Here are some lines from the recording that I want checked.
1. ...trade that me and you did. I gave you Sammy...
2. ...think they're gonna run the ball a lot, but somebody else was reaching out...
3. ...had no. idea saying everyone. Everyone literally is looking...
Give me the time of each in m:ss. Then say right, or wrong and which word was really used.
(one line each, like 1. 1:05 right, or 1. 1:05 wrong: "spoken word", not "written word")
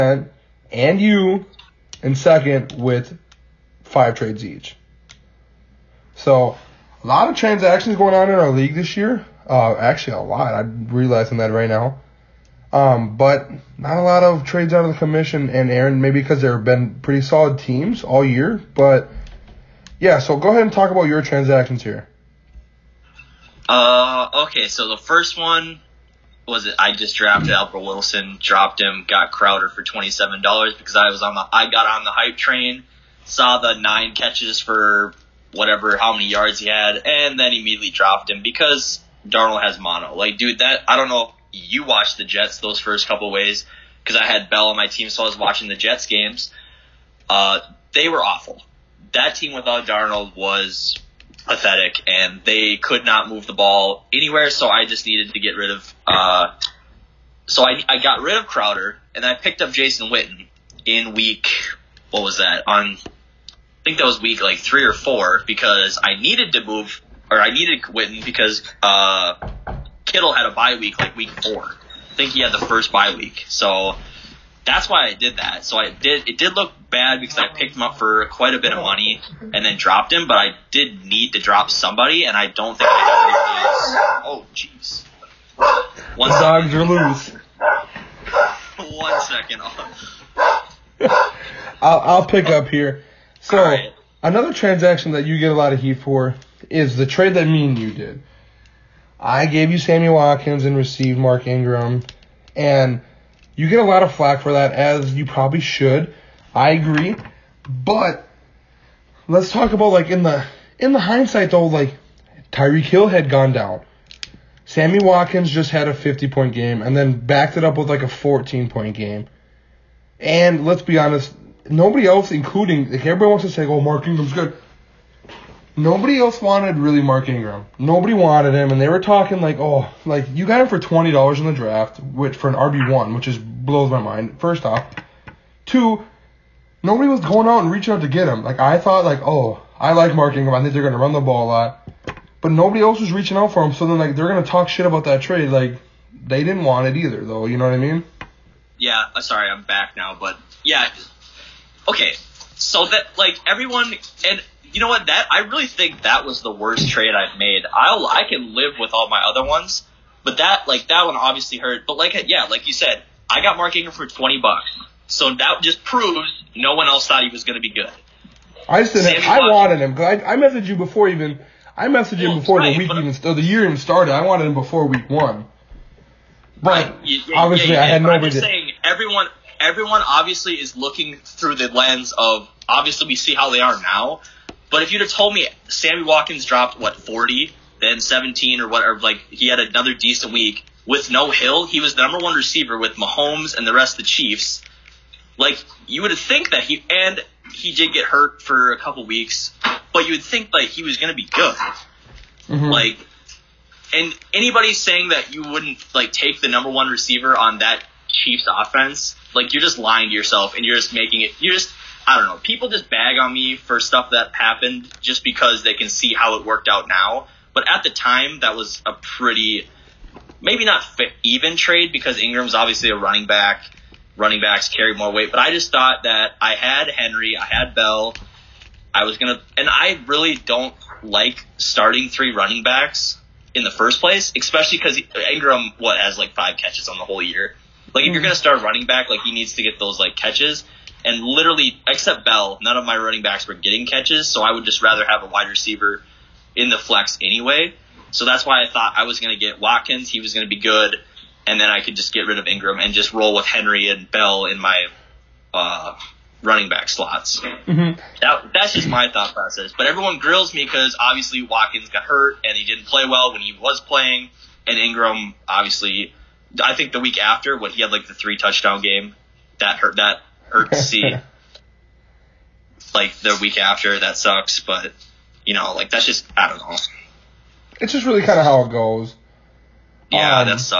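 1. 1:37 right
2. 2:20 wrong: "nobody", not "somebody"
3. 2:57 wrong: "obviously", not "literally".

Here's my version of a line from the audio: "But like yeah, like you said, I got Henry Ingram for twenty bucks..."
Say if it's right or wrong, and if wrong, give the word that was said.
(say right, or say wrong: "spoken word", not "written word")
wrong: "Mark", not "Henry".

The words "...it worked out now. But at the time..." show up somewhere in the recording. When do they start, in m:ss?
3:36.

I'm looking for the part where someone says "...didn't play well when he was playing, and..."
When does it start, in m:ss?
4:22.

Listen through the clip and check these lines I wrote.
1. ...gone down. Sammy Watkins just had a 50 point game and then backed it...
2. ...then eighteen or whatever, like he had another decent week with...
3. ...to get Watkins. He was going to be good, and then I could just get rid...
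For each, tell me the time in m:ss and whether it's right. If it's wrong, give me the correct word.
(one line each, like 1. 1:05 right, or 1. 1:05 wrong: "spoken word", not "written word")
1. 1:53 right
2. 3:07 wrong: "seventeen", not "eighteen"
3. 4:09 right.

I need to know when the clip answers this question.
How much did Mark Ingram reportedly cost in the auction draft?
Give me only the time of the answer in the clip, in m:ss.
2:10.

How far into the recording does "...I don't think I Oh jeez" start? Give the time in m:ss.
1:22.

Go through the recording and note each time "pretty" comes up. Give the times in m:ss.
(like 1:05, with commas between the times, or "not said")
0:17, 3:38.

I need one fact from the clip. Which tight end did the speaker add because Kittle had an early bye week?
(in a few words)
Jason Witten.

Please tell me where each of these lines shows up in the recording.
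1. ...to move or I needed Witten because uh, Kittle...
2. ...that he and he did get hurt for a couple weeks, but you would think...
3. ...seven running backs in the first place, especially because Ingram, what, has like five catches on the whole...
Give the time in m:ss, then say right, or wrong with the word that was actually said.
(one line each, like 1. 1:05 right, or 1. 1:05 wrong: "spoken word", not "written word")
1. 1:06 right
2. 3:16 right
3. 3:52 wrong: "three", not "seven".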